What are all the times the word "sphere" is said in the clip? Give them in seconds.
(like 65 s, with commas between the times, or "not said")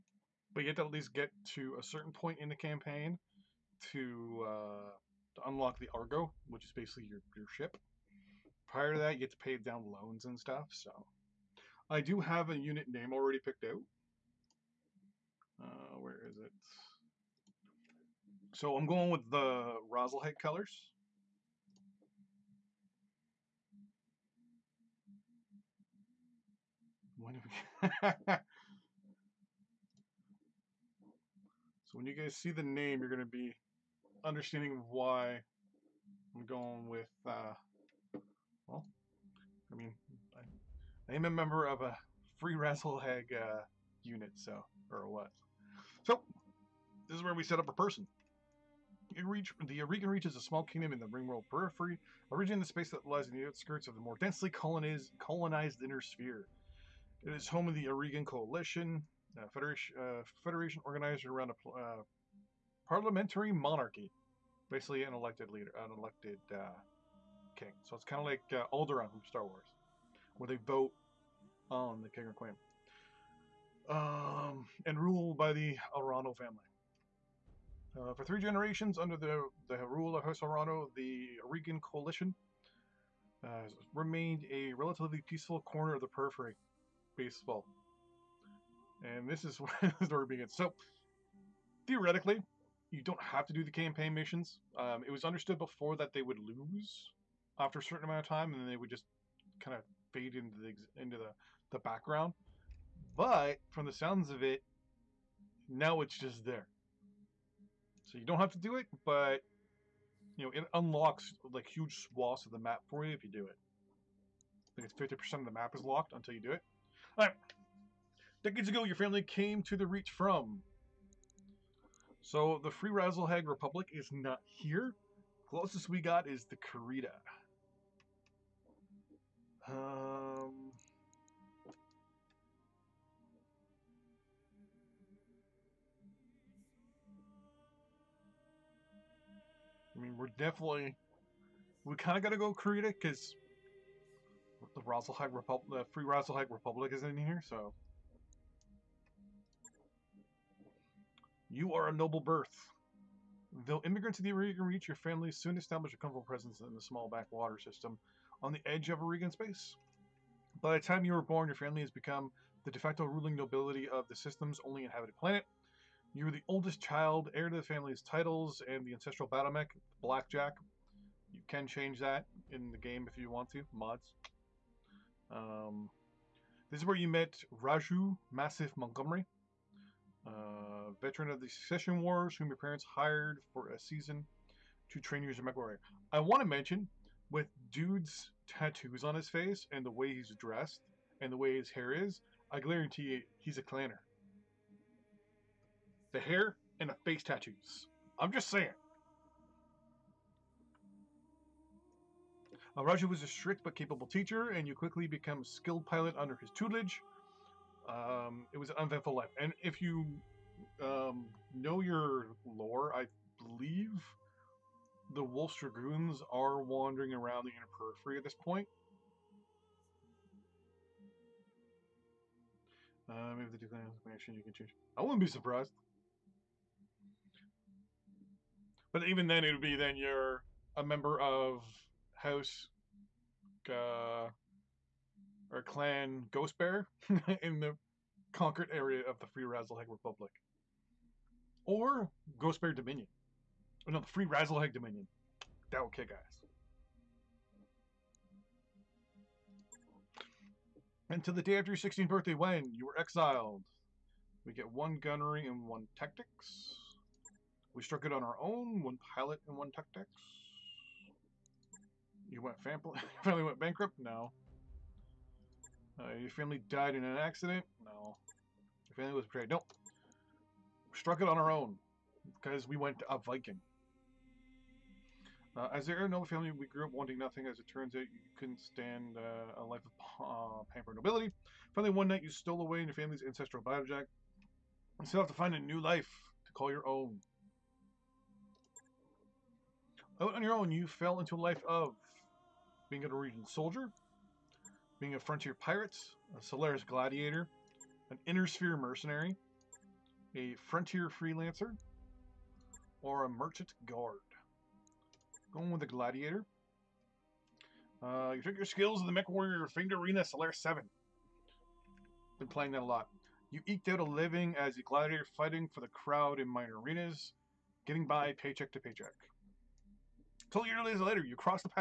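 55 s, 298 s.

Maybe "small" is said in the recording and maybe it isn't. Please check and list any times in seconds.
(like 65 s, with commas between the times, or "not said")
50 s, 156 s.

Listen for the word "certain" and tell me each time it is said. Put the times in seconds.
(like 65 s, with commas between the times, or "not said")
1 s, 97 s.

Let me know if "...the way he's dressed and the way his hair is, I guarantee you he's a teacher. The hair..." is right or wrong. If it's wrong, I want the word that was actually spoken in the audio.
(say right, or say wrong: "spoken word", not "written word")
wrong: "clanner", not "teacher".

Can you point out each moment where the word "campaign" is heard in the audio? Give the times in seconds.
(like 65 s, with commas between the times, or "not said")
2 s, 93 s.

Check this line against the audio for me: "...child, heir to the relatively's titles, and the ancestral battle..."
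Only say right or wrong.
wrong.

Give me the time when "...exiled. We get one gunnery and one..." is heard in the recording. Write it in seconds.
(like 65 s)
252 s.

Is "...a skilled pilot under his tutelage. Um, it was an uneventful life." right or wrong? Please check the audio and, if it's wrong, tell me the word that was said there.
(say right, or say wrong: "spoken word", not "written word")
right.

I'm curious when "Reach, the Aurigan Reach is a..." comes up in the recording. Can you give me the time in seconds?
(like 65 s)
49 s.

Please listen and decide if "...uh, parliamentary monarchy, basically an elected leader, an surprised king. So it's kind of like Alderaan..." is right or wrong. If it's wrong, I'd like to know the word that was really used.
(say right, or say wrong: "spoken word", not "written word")
wrong: "elected", not "surprised".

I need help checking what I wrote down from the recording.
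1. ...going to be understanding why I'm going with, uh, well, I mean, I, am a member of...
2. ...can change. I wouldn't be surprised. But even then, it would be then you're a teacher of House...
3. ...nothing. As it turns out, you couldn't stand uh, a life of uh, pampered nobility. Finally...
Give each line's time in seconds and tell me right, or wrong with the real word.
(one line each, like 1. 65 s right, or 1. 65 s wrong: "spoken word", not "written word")
1. 33 s right
2. 224 s wrong: "member", not "teacher"
3. 277 s right.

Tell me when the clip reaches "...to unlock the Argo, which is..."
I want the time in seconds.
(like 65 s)
5 s.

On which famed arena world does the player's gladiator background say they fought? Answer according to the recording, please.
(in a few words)
Solaris 7.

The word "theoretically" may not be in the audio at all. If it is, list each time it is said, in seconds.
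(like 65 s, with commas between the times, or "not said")
91 s.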